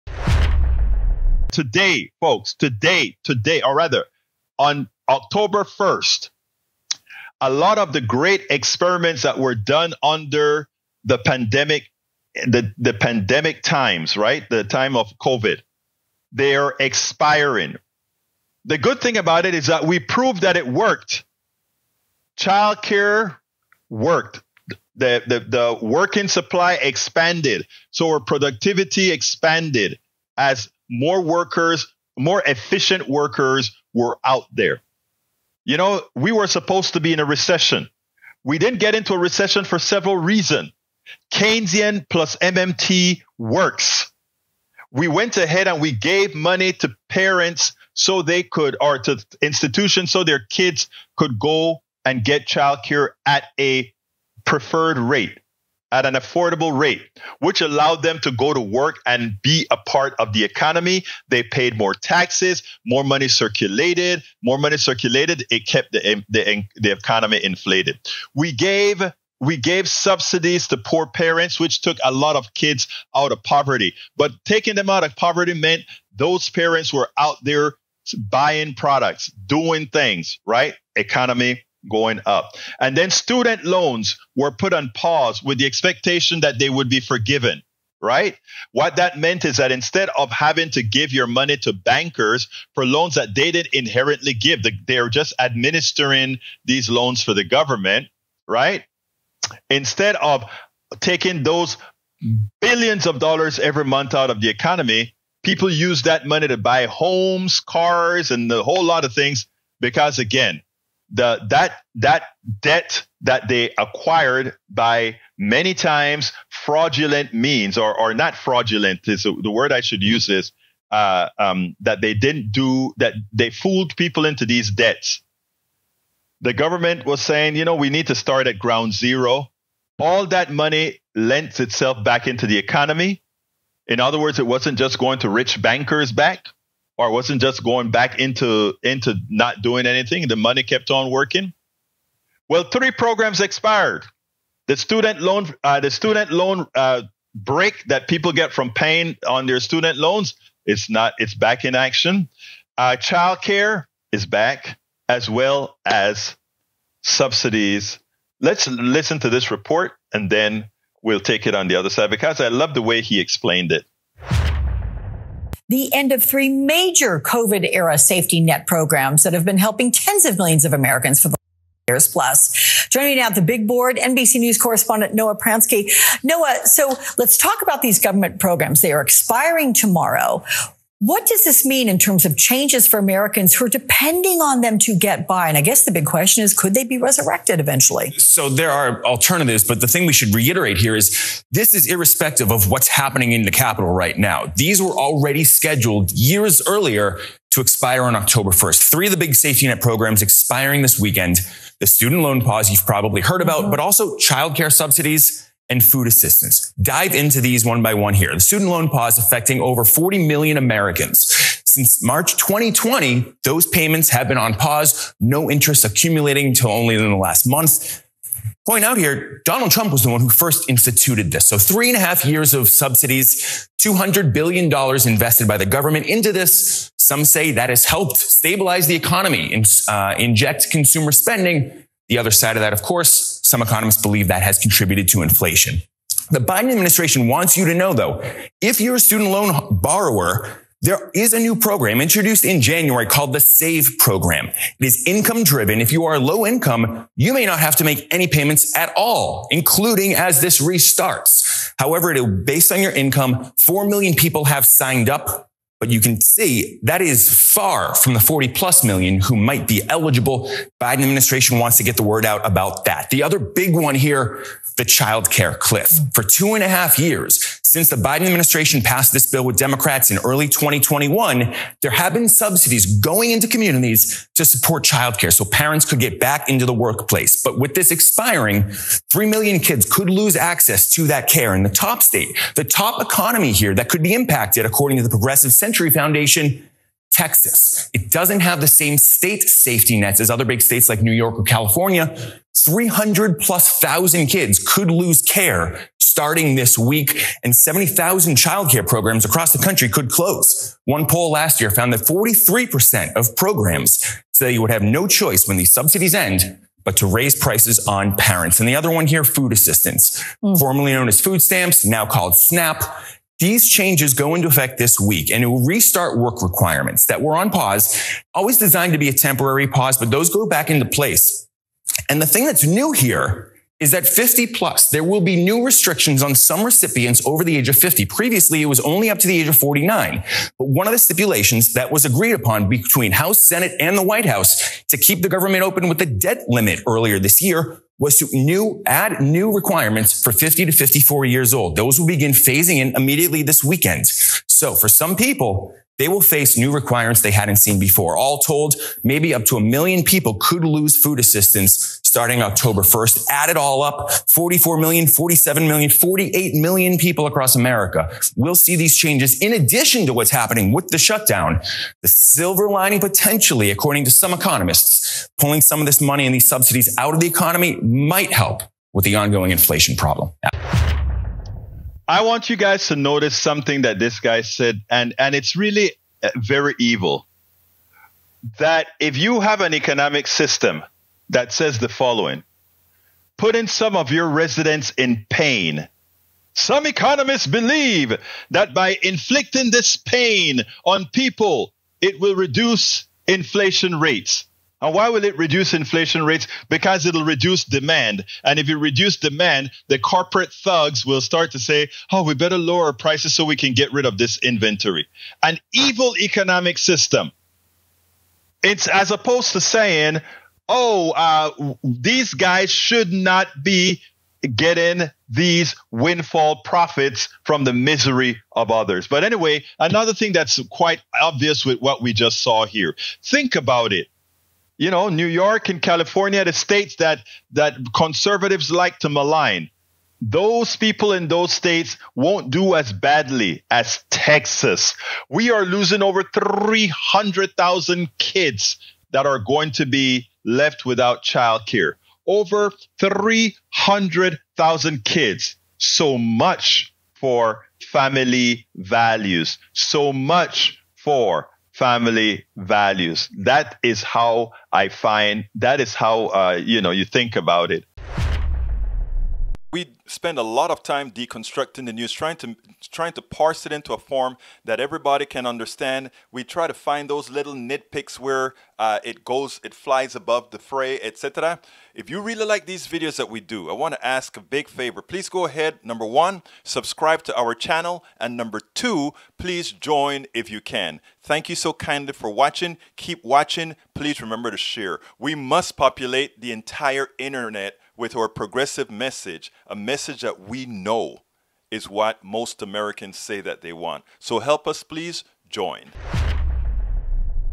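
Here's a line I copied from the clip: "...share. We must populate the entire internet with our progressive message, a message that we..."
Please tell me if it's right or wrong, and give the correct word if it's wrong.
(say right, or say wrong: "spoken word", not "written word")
right.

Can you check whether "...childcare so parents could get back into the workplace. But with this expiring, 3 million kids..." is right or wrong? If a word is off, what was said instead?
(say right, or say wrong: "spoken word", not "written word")
right.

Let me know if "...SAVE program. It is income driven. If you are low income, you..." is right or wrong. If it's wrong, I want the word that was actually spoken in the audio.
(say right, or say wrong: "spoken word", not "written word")
right.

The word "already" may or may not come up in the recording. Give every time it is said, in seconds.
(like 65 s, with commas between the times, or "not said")
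194 s.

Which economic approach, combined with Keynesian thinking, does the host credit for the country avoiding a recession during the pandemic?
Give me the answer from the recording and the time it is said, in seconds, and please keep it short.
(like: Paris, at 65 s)
MMT, at 42 s.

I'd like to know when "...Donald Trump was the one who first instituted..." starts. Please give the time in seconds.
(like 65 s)
219 s.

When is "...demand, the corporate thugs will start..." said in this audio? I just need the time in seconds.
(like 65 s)
399 s.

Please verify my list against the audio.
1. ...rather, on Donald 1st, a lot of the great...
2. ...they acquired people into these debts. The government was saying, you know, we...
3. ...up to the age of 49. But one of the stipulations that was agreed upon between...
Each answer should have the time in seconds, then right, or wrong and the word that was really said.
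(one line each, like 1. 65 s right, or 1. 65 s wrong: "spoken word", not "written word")
1. 3 s wrong: "October", not "Donald"
2. 123 s wrong: "fooled", not "acquired"
3. 329 s right.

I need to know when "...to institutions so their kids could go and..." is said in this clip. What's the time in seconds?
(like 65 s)
48 s.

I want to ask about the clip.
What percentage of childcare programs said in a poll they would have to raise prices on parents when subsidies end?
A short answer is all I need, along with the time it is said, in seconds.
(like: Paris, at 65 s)
43%, at 302 s.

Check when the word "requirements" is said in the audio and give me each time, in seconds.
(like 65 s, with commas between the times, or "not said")
316 s, 339 s, 346 s.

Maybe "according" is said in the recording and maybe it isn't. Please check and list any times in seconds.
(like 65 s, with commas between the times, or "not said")
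284 s, 363 s.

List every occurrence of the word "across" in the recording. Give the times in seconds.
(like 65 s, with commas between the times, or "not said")
299 s, 357 s.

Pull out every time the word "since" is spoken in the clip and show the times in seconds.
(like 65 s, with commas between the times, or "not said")
211 s, 267 s.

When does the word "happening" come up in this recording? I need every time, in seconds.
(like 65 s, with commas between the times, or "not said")
192 s, 360 s.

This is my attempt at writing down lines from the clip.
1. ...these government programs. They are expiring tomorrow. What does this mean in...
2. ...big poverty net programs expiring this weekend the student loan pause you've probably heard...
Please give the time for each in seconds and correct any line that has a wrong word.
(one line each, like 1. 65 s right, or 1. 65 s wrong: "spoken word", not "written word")
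1. 177 s right
2. 199 s wrong: "safety", not "poverty".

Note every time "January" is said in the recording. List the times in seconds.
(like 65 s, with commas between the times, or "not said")
242 s.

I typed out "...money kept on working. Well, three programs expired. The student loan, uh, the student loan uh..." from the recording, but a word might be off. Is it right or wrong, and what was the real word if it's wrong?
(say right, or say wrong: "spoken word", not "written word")
right.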